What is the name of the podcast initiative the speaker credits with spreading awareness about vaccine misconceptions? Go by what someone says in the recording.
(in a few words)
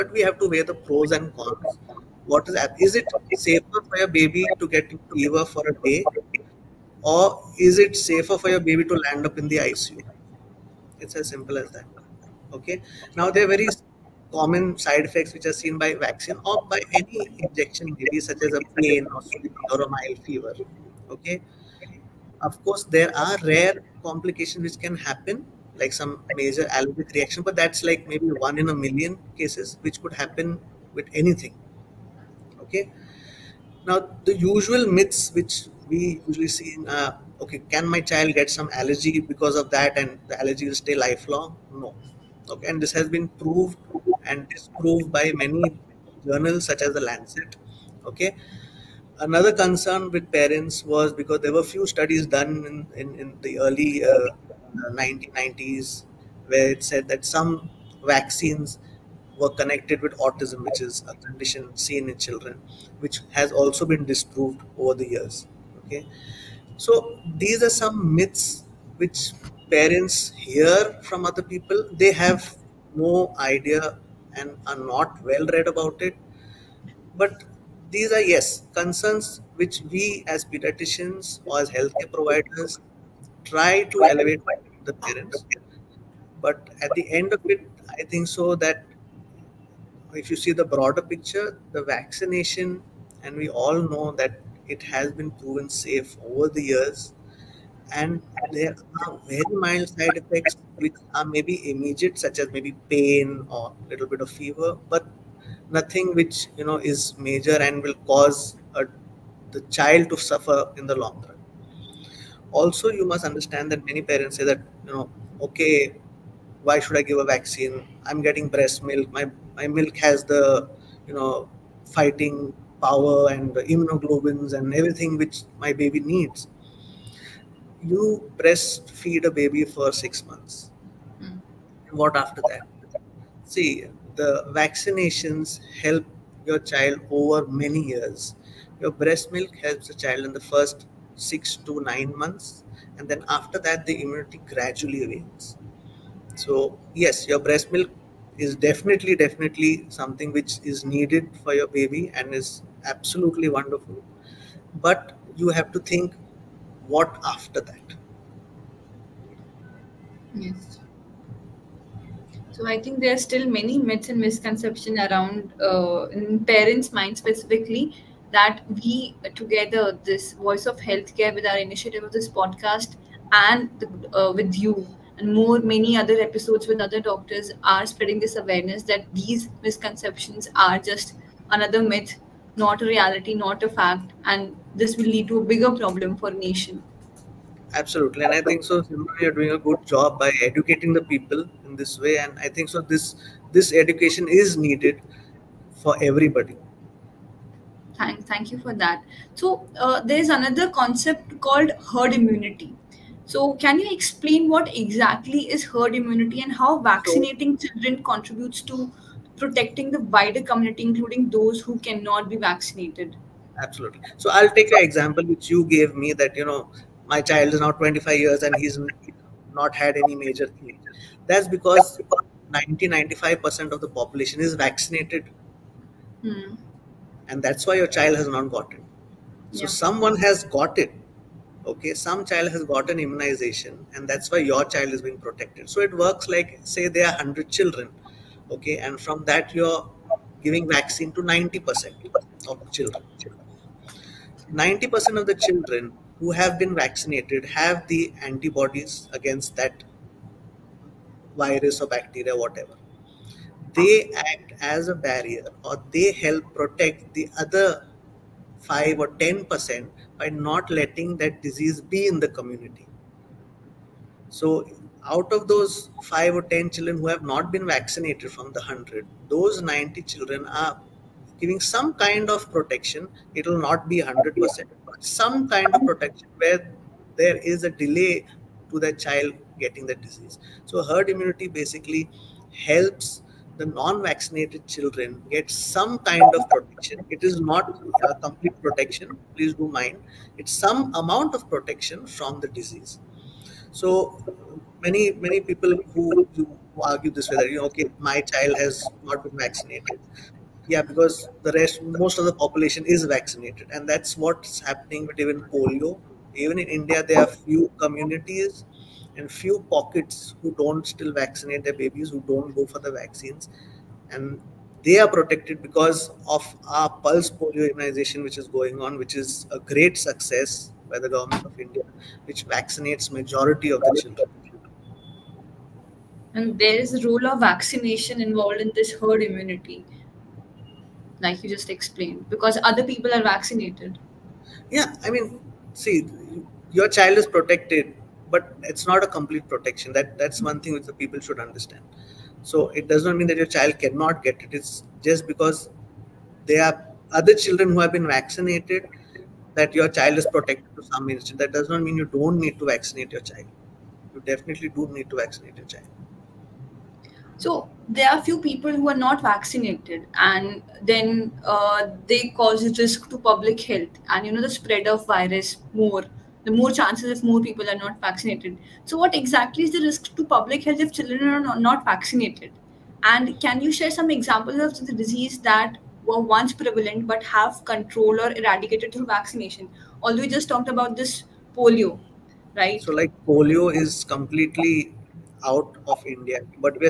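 Voice of Healthcare.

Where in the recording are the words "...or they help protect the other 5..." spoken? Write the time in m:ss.
4:15.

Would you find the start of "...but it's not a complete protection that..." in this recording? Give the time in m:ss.
5:38.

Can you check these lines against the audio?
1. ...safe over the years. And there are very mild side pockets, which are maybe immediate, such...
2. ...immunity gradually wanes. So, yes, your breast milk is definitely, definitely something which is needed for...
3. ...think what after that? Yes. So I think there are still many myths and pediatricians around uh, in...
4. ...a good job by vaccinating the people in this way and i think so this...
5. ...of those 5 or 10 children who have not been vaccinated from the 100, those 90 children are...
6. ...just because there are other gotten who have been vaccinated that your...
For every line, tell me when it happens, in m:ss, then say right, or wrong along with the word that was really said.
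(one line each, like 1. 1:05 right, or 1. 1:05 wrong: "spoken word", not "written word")
1. 1:35 wrong: "effects", not "pockets"
2. 2:24 right
3. 2:35 wrong: "misconceptions", not "pediatricians"
4. 3:09 wrong: "educating", not "vaccinating"
5. 4:25 right
6. 5:45 wrong: "children", not "gotten".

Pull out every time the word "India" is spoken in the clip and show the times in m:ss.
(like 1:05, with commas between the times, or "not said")
5:06, 5:21, 6:26.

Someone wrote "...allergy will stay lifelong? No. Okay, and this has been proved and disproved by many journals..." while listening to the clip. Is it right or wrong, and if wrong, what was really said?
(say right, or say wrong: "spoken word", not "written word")
right.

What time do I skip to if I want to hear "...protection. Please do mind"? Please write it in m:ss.
4:48.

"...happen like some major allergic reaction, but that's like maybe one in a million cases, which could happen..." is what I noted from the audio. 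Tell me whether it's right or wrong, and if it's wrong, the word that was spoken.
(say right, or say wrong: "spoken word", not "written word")
right.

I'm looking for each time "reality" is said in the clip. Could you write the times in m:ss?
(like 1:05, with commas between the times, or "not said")
3:02.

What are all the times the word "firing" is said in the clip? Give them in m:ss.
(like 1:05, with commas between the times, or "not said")
not said.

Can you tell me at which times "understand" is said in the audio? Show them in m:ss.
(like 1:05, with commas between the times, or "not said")
1:53, 5:41.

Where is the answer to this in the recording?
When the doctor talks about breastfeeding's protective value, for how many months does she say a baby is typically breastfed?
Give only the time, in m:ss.
2:09.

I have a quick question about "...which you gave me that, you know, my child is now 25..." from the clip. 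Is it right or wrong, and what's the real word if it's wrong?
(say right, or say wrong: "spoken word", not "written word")
right.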